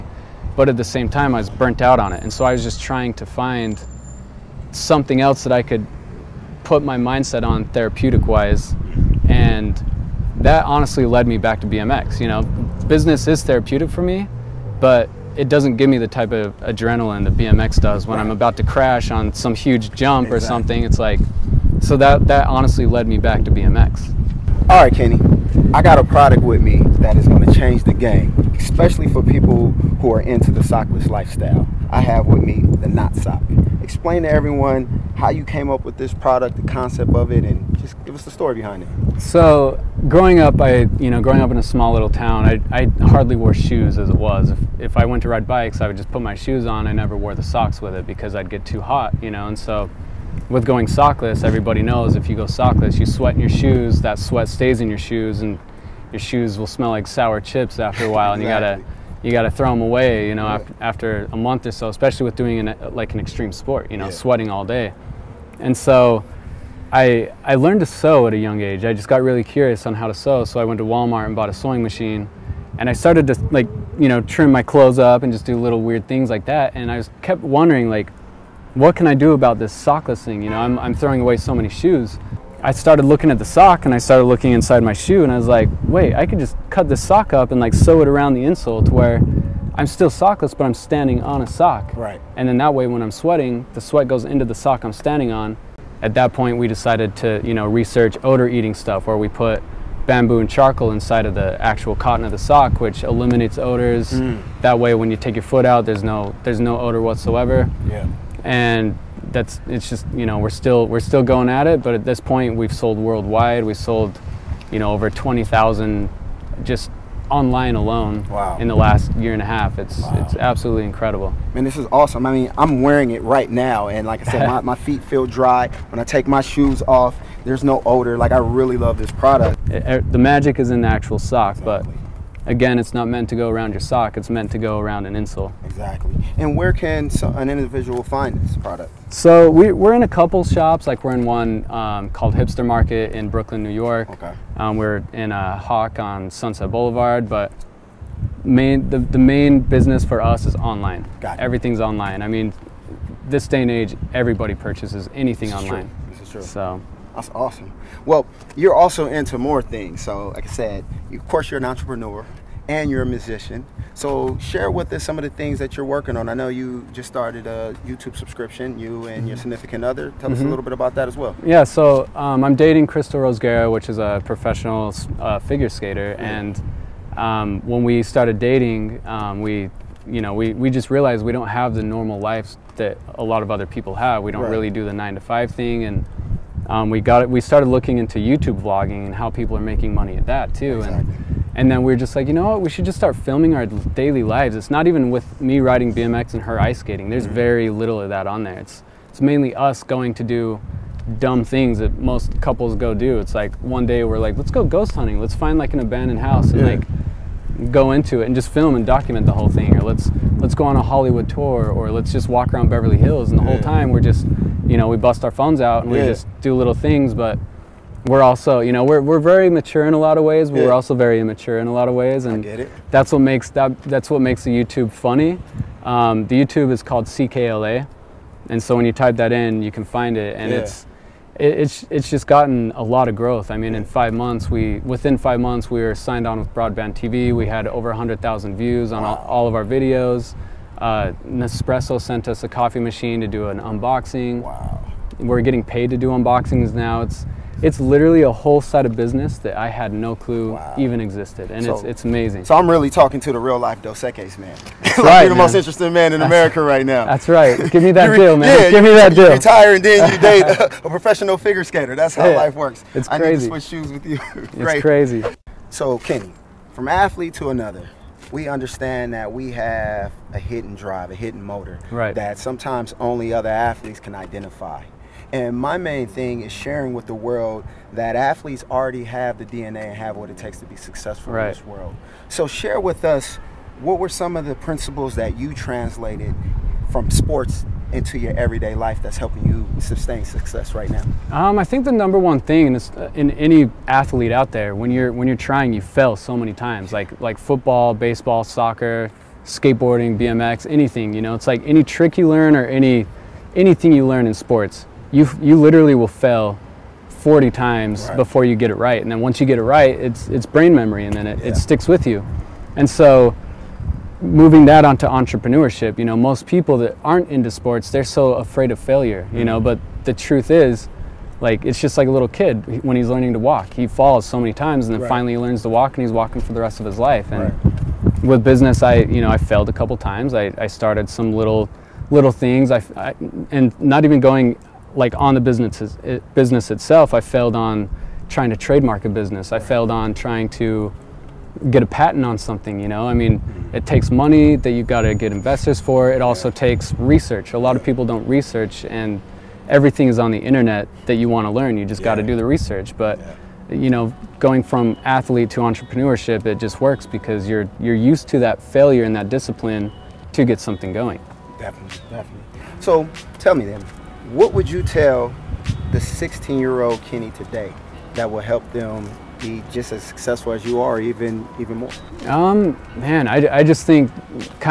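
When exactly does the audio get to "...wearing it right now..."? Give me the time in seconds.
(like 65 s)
122 s.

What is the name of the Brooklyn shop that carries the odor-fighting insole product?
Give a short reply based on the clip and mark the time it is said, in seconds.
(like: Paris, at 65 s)
Hipster Market, at 142 s.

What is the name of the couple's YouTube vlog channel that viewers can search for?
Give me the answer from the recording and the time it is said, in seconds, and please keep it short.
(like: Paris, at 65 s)
CKLA, at 227 s.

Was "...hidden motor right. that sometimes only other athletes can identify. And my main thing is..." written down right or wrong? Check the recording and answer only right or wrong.
right.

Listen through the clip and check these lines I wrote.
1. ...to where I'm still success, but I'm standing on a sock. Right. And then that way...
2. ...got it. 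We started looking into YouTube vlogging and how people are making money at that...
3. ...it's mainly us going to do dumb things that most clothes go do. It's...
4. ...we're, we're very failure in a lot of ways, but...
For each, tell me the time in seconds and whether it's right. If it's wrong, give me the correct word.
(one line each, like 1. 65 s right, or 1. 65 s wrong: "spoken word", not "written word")
1. 88 s wrong: "sockless", not "success"
2. 187 s right
3. 199 s wrong: "couples", not "clothes"
4. 218 s wrong: "mature", not "failure".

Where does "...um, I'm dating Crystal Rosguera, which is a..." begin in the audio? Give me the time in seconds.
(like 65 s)
172 s.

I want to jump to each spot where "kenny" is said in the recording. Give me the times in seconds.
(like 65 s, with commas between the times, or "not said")
24 s, 265 s, 367 s.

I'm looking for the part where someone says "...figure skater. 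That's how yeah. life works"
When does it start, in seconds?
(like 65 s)
261 s.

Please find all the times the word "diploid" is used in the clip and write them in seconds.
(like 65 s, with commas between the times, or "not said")
not said.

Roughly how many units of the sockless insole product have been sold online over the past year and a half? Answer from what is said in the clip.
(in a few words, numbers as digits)
20,000.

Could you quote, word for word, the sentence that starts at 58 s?
you gotta you gotta throw them away, you know, yeah.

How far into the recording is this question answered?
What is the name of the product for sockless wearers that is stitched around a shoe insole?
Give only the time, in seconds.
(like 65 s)
32 s.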